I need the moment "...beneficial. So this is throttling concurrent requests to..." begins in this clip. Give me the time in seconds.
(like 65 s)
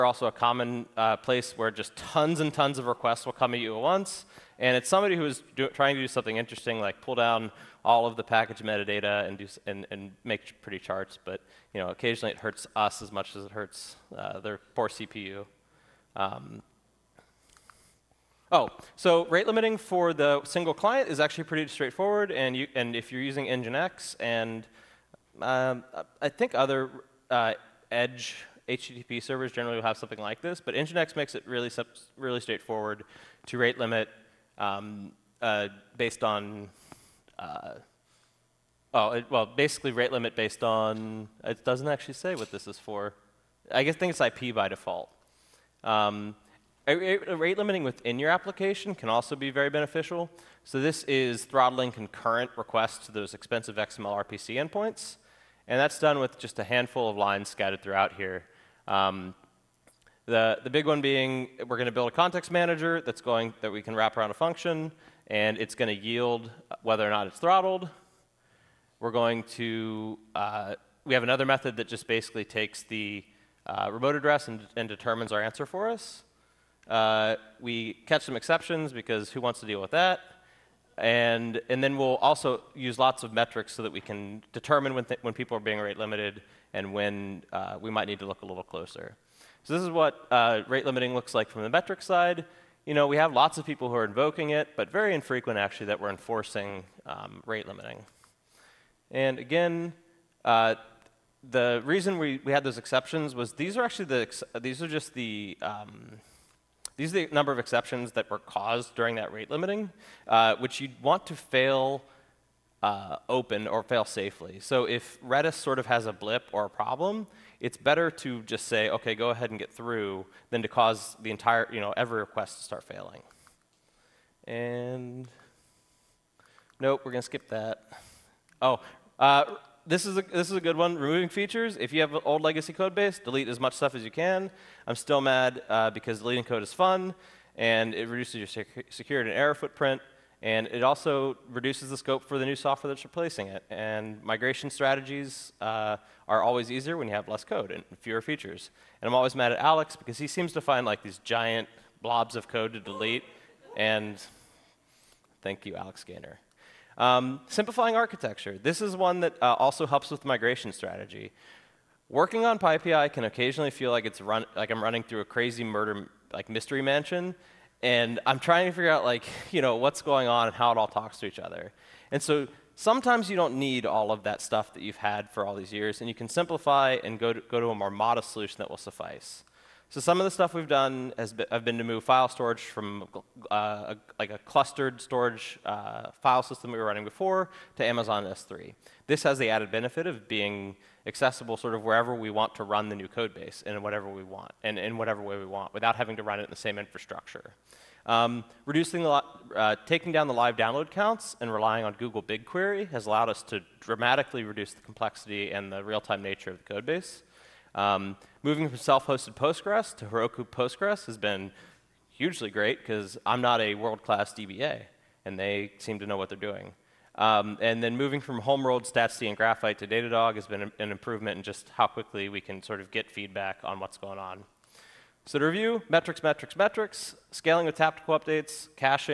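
49 s.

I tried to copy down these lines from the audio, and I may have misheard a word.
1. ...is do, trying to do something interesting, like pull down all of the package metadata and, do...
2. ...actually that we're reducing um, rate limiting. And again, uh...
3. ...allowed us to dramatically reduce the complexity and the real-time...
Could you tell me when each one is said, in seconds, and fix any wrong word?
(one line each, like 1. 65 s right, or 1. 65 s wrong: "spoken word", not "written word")
1. 5 s right
2. 95 s wrong: "enforcing", not "reducing"
3. 203 s right.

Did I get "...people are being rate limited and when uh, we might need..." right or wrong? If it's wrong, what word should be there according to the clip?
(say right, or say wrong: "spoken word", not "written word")
right.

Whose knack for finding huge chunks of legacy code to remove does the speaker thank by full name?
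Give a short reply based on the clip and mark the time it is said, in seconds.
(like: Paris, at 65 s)
Alex Gaynor, at 155 s.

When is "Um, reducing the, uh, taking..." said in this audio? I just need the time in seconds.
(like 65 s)
198 s.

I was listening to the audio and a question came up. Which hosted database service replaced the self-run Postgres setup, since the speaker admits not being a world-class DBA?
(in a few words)
Heroku Postgres.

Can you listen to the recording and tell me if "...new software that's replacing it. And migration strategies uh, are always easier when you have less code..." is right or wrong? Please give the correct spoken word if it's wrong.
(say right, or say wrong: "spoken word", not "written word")
right.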